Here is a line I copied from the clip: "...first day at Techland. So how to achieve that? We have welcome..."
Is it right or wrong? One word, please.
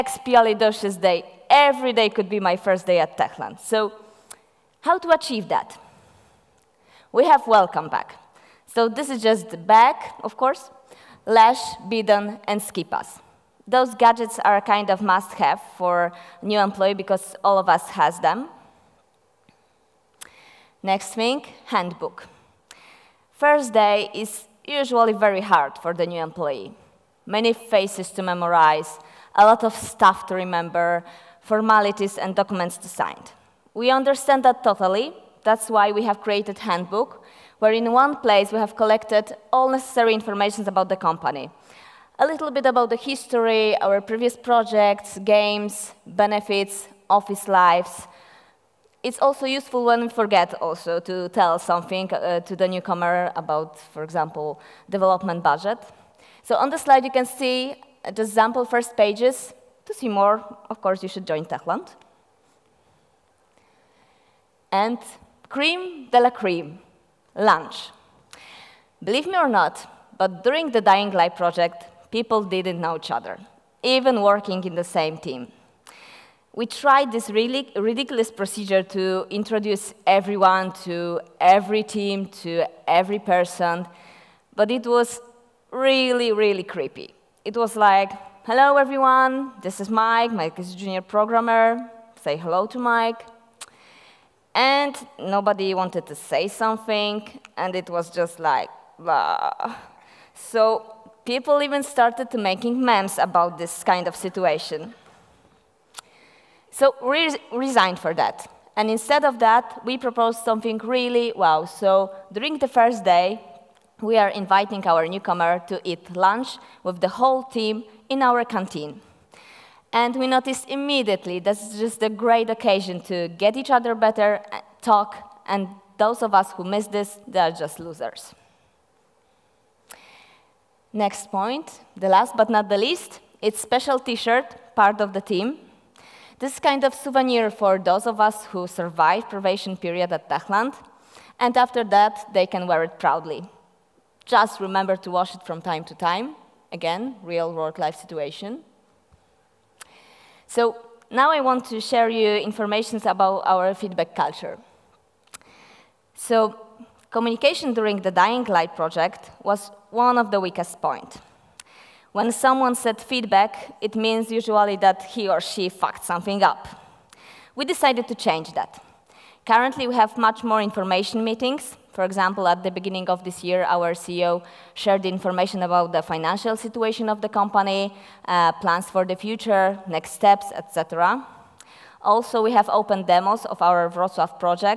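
right.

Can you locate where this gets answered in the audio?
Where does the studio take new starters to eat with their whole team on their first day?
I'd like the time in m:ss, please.
1:58.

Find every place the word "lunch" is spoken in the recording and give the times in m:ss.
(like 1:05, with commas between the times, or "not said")
1:07, 1:56.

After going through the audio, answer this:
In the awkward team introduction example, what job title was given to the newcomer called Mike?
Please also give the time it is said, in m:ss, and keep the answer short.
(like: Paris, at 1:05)
junior programmer, at 1:30.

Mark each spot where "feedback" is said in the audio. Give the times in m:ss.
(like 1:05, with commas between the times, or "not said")
2:33, 2:43.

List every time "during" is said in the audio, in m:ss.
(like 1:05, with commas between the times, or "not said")
1:10, 1:52, 2:37.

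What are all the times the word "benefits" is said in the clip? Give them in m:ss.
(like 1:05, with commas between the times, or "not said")
0:46.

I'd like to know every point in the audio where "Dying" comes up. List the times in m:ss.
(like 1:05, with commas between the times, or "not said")
1:10, 2:38.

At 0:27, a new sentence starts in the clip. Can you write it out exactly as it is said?
Many faces to memorize, a lot of stuff to remember, formalities and documents to sign.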